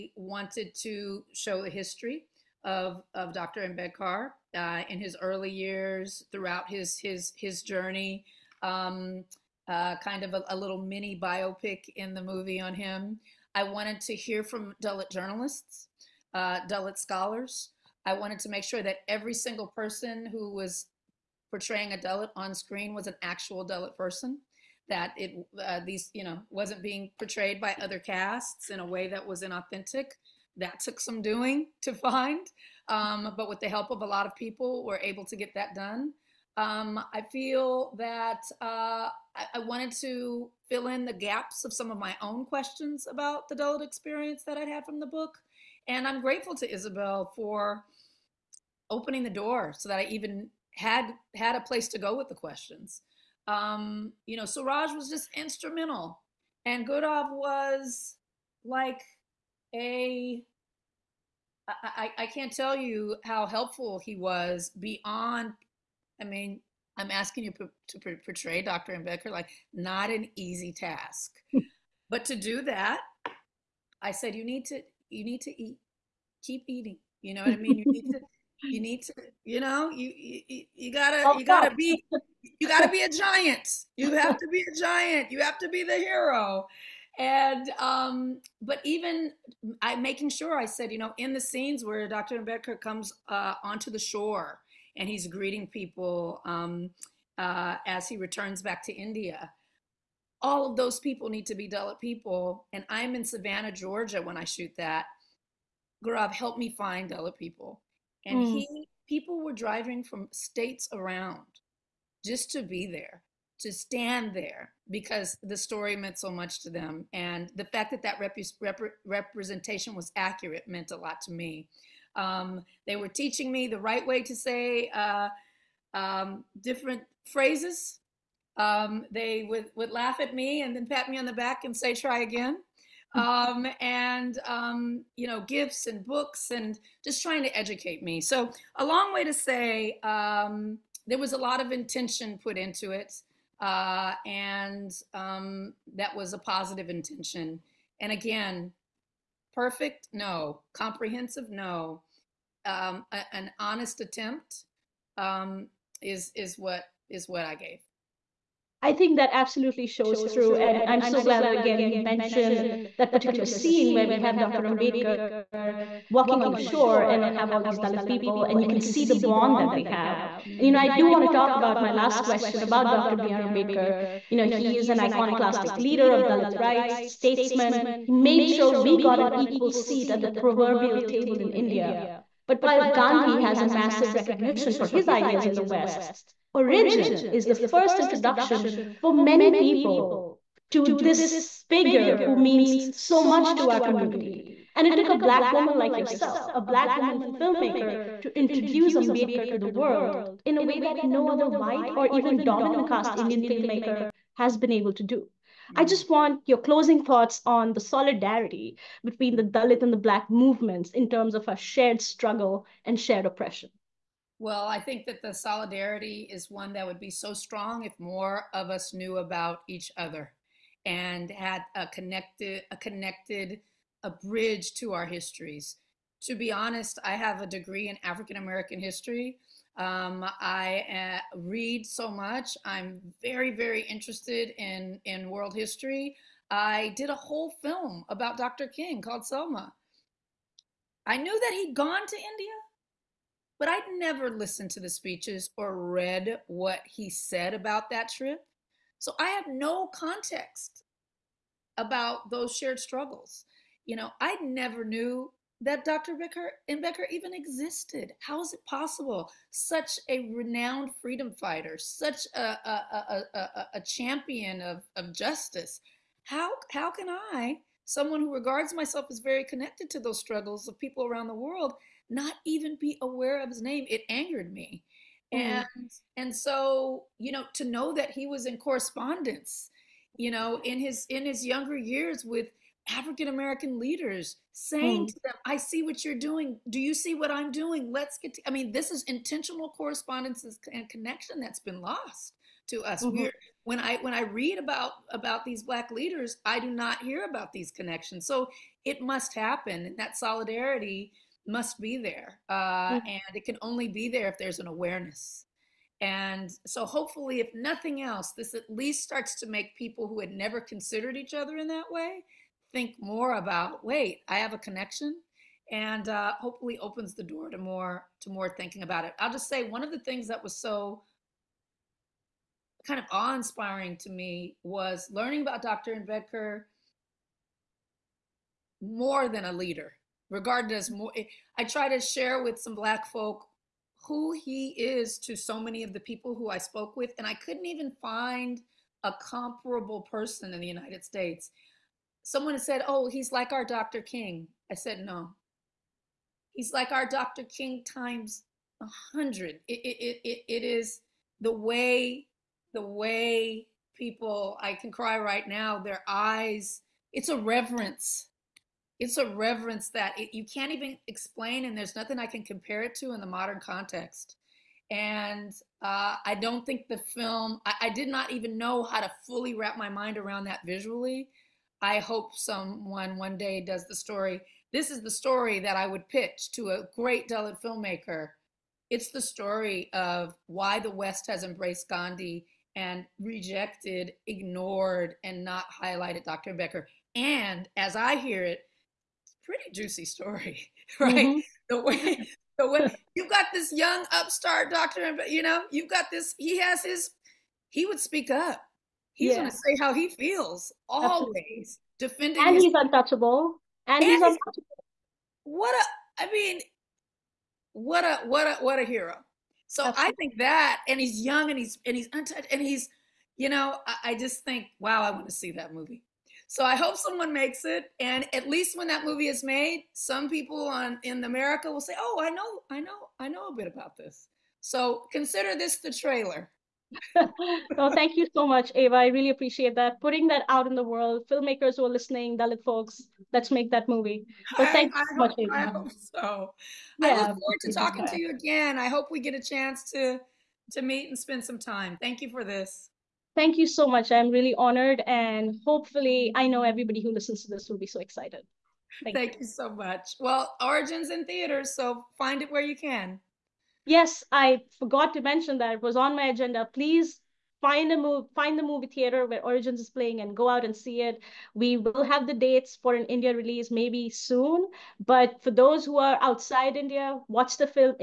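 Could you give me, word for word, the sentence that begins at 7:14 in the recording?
So thank I, you so much, hope, Ava.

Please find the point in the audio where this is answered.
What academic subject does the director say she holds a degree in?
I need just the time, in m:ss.
3:48.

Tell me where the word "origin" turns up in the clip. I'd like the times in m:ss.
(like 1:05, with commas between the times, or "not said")
3:06, 7:30, 7:39.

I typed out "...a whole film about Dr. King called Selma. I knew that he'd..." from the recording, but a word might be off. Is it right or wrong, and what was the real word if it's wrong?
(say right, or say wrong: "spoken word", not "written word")
right.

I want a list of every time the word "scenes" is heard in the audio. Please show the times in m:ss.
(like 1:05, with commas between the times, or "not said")
1:31, 2:43.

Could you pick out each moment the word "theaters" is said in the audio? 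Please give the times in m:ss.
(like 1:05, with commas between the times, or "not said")
7:31, 7:38.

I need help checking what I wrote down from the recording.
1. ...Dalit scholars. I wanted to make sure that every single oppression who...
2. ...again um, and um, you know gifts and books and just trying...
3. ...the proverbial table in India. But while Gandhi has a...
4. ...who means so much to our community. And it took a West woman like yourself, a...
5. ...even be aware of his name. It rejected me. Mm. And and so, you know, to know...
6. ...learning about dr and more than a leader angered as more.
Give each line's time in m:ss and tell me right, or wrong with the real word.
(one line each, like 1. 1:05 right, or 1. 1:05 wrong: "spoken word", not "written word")
1. 0:16 wrong: "person", not "oppression"
2. 2:12 right
3. 3:00 right
4. 3:12 wrong: "Black", not "West"
5. 4:32 wrong: "angered", not "rejected"
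6. 5:25 wrong: "regarded", not "angered".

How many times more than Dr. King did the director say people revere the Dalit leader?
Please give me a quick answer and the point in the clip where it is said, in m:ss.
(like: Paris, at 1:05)
100, at 5:48.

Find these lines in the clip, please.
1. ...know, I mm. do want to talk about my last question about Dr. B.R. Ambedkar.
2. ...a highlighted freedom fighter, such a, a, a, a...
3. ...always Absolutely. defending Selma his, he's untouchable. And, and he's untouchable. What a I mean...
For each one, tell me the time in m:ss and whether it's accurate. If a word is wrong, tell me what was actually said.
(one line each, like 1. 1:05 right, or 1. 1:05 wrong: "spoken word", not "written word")
1. 2:50 right
2. 4:20 wrong: "renowned", not "highlighted"
3. 6:40 wrong: "And", not "Selma".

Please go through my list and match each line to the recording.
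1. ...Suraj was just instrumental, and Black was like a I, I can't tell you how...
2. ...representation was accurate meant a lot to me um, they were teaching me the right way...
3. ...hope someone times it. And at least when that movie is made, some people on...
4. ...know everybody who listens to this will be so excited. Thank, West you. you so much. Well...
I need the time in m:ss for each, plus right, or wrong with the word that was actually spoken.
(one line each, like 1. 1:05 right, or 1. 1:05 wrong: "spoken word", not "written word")
1. 0:54 wrong: "Gaurav", not "Black"
2. 1:59 right
3. 6:56 wrong: "makes", not "times"
4. 7:26 wrong: "Thank", not "West".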